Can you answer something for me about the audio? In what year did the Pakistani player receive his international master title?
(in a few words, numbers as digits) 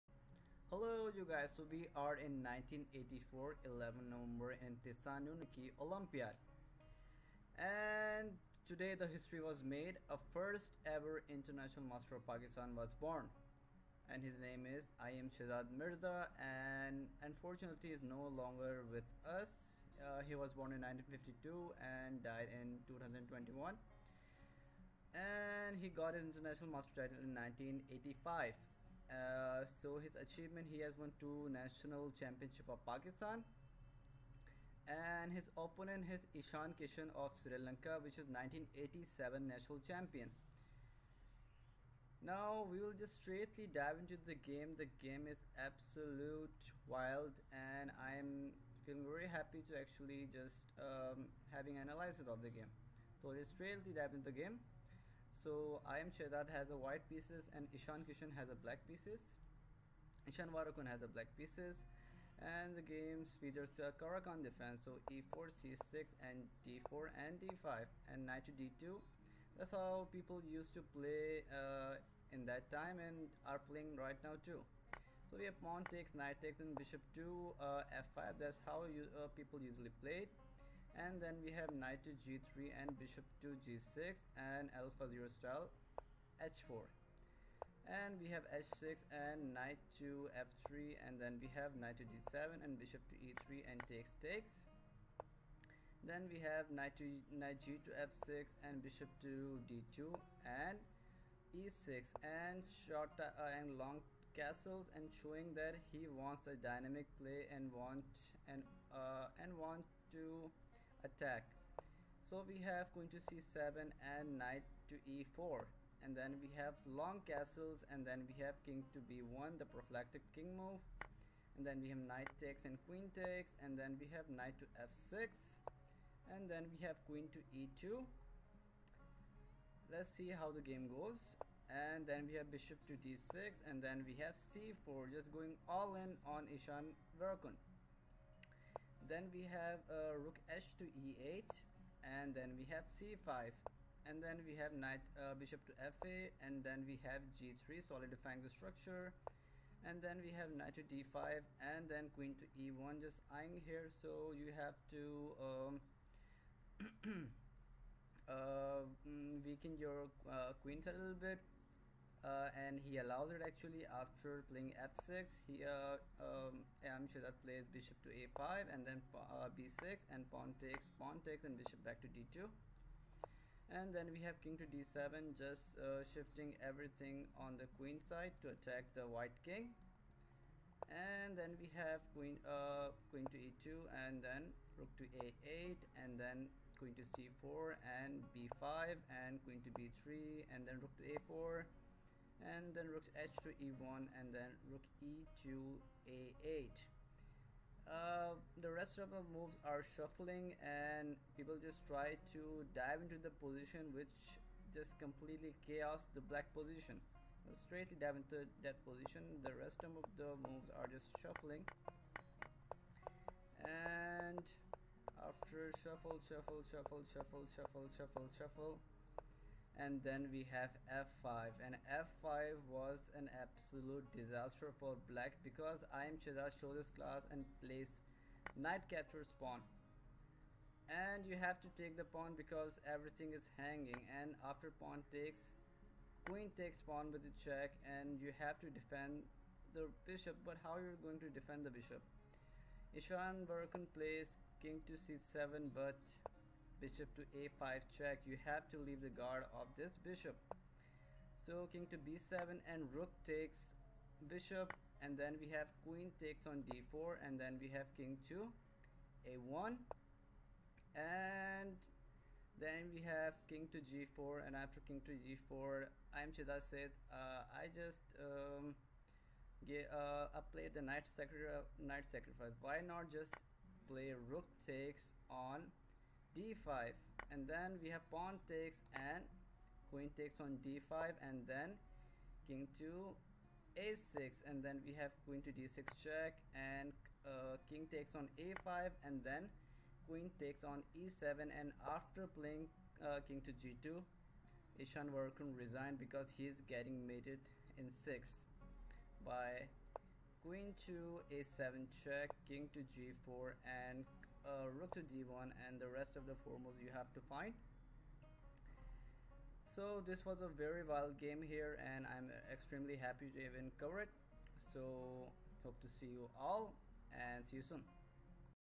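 1985.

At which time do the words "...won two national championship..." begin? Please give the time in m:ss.
0:30.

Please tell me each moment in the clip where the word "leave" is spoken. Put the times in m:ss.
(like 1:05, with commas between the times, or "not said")
4:08.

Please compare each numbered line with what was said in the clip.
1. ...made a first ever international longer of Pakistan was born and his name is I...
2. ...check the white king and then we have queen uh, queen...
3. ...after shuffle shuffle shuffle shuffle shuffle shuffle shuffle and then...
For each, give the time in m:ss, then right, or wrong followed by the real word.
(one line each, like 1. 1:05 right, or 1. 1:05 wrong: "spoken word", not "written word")
1. 0:09 wrong: "master", not "longer"
2. 2:58 wrong: "attack", not "check"
3. 3:35 right.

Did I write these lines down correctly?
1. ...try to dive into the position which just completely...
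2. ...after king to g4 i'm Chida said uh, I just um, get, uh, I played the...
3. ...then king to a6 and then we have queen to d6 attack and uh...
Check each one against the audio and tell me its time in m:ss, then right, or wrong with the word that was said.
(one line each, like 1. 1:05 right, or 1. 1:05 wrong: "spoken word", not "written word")
1. 3:21 right
2. 4:24 right
3. 4:41 wrong: "check", not "attack".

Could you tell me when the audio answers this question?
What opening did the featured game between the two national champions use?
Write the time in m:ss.
1:04.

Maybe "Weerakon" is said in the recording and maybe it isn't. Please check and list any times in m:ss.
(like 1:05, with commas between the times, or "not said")
1:00, 2:17, 4:03, 4:55.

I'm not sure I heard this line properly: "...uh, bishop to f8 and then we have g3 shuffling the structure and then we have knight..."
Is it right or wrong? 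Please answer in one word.
wrong.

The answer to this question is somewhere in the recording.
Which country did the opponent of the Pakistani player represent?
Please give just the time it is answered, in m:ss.
0:37.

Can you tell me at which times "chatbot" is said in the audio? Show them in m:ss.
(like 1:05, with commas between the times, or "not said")
not said.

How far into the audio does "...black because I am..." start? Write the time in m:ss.
3:45.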